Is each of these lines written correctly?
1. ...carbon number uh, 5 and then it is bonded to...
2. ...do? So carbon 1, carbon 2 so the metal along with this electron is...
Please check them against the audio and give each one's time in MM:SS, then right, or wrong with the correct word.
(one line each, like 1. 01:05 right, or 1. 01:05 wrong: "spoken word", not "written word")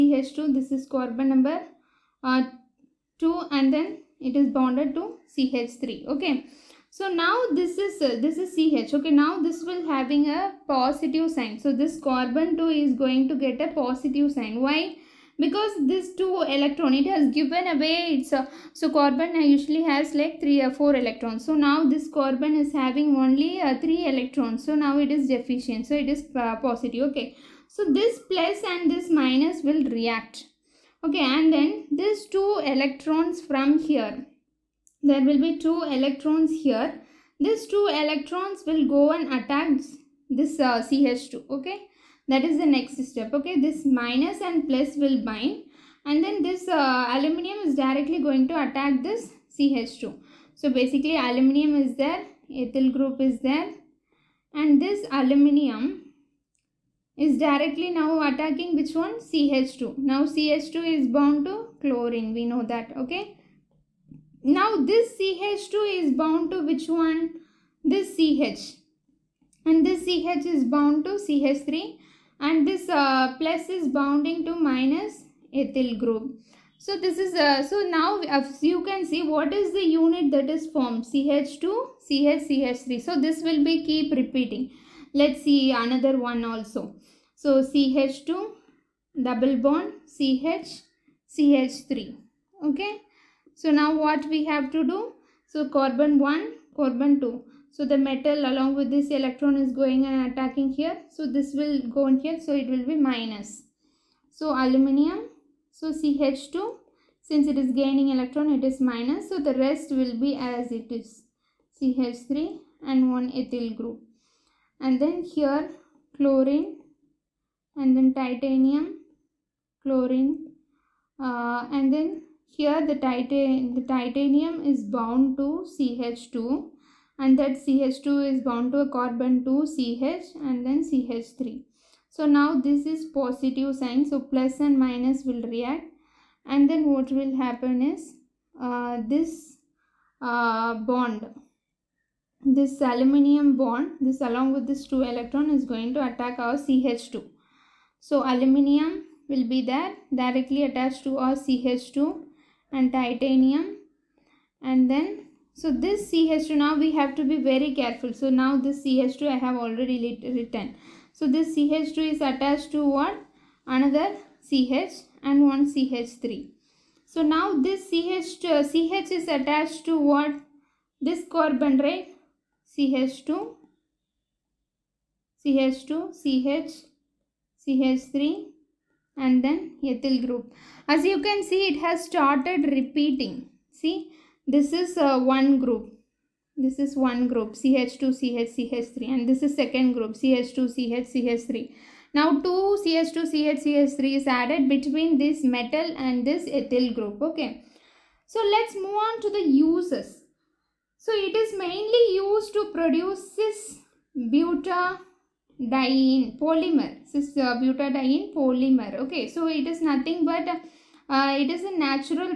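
1. 00:00 wrong: "2", not "5"
2. 01:34 right.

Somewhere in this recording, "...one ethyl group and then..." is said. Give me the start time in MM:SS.
01:53.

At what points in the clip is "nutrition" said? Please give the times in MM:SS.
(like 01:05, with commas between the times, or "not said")
not said.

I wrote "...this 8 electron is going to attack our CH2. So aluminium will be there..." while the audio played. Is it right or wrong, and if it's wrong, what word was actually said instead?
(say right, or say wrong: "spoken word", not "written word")
wrong: "2", not "8".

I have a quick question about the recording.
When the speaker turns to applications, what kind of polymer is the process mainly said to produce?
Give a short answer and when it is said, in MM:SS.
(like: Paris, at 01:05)
cis butadiene polymer, at 03:23.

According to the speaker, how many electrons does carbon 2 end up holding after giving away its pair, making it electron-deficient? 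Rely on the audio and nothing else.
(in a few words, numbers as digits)
3.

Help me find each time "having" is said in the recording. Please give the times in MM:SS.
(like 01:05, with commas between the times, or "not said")
00:09, 00:22.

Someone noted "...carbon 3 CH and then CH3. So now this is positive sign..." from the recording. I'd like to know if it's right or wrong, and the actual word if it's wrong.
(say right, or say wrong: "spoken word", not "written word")
wrong: "2", not "3".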